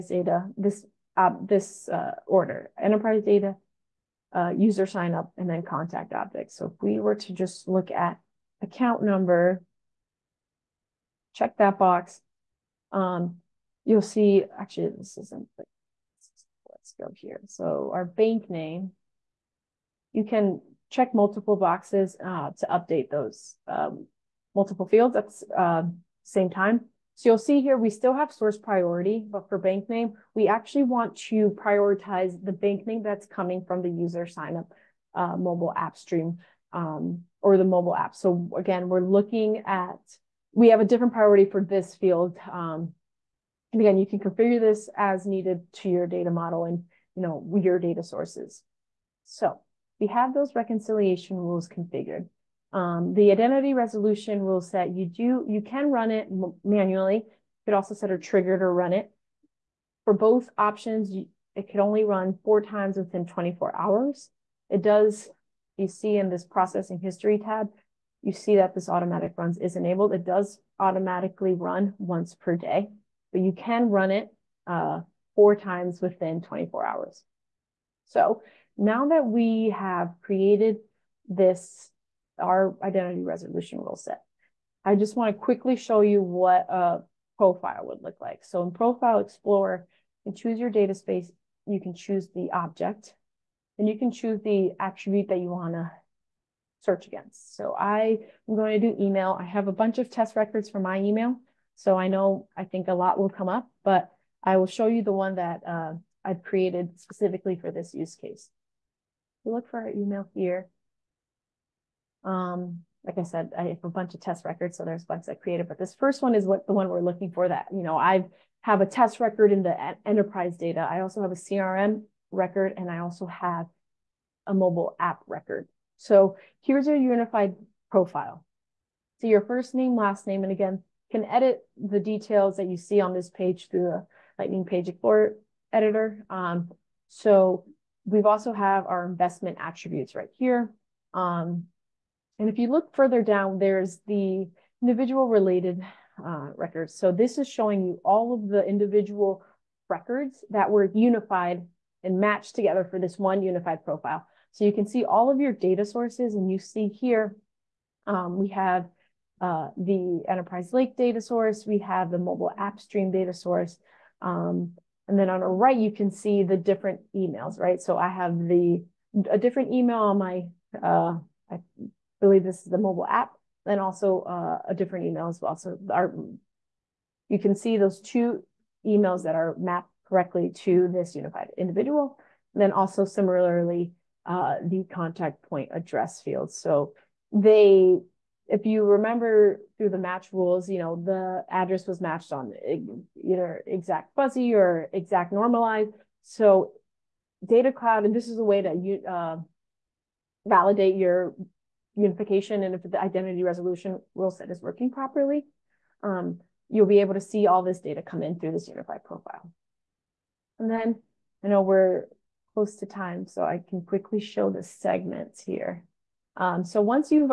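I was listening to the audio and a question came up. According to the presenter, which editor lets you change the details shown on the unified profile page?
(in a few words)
Lightning Page Explorer editor.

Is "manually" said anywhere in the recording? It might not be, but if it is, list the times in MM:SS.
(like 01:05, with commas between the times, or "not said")
00:56.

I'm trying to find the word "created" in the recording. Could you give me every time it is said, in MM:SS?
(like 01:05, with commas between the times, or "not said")
01:20, 01:46, 01:55.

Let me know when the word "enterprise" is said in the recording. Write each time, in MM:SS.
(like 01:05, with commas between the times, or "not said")
00:02, 02:00, 02:40.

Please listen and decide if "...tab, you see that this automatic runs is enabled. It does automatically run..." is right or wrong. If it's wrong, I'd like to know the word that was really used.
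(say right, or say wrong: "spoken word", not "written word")
right.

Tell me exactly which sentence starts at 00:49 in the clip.
So we have those reconciliation rules configured.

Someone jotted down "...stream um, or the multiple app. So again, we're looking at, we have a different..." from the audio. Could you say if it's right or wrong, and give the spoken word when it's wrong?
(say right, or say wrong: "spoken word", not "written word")
wrong: "mobile", not "multiple".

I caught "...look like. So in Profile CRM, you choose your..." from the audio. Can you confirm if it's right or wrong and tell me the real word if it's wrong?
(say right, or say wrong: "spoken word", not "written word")
wrong: "Explorer", not "CRM".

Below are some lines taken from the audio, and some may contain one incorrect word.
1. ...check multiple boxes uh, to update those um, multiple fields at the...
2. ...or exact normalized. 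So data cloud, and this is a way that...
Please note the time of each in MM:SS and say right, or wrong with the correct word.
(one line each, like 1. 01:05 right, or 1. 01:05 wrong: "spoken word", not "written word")
1. 00:20 right
2. 03:14 right.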